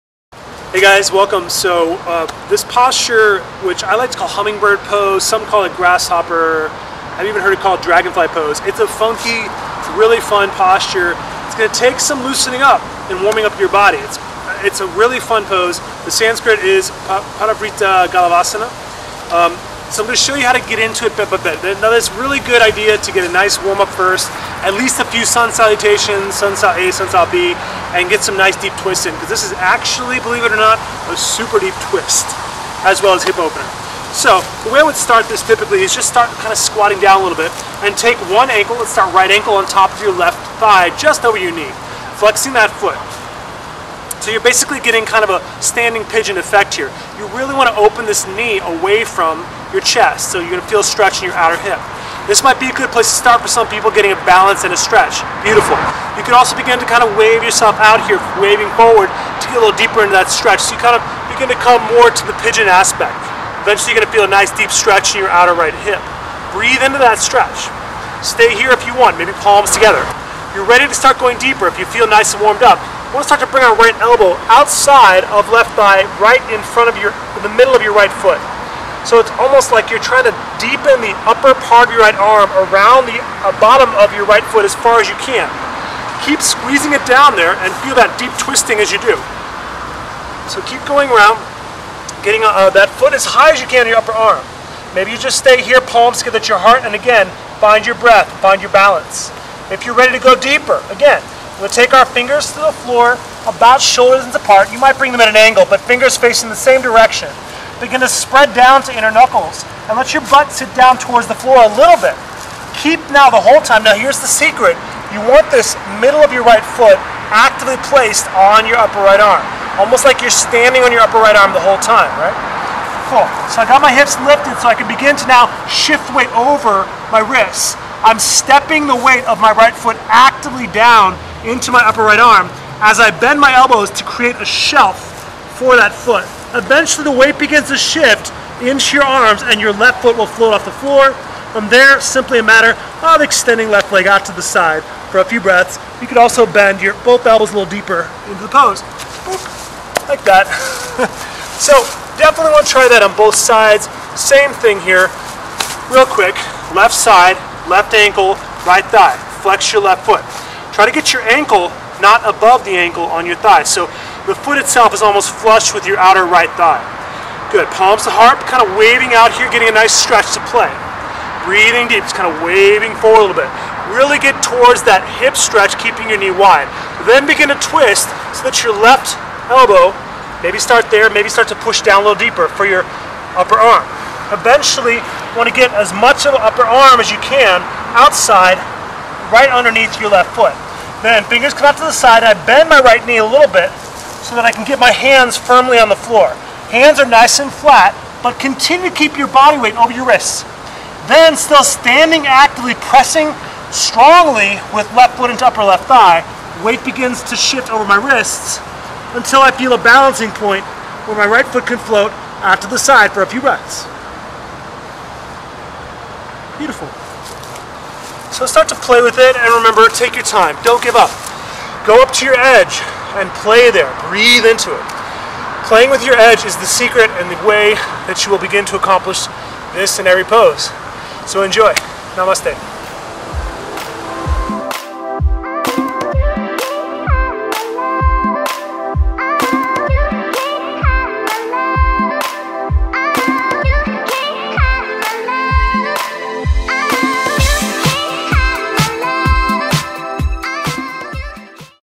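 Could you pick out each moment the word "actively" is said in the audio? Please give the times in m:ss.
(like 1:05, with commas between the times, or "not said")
1:57, 2:10, 3:22.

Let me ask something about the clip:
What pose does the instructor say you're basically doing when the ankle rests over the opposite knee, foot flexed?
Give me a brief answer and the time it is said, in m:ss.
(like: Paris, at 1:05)
Standing pigeon, at 0:45.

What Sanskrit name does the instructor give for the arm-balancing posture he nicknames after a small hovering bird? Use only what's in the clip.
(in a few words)
Parivrtta Galavasana.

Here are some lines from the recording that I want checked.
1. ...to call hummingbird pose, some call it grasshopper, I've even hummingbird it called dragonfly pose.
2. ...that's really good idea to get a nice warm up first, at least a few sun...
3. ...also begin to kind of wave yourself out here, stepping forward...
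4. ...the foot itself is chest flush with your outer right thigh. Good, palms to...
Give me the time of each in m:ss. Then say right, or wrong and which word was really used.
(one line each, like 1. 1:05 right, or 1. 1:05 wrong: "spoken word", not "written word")
1. 0:04 wrong: "heard", not "hummingbird"
2. 0:21 right
3. 0:56 wrong: "waving", not "stepping"
4. 2:44 wrong: "almost", not "chest".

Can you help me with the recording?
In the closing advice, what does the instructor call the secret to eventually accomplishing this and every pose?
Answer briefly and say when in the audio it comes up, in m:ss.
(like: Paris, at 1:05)
Playing with your edge, at 3:45.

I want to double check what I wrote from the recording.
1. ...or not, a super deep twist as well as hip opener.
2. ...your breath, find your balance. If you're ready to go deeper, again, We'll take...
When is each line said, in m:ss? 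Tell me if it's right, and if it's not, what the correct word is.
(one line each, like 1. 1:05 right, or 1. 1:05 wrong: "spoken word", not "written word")
1. 0:30 right
2. 1:37 right.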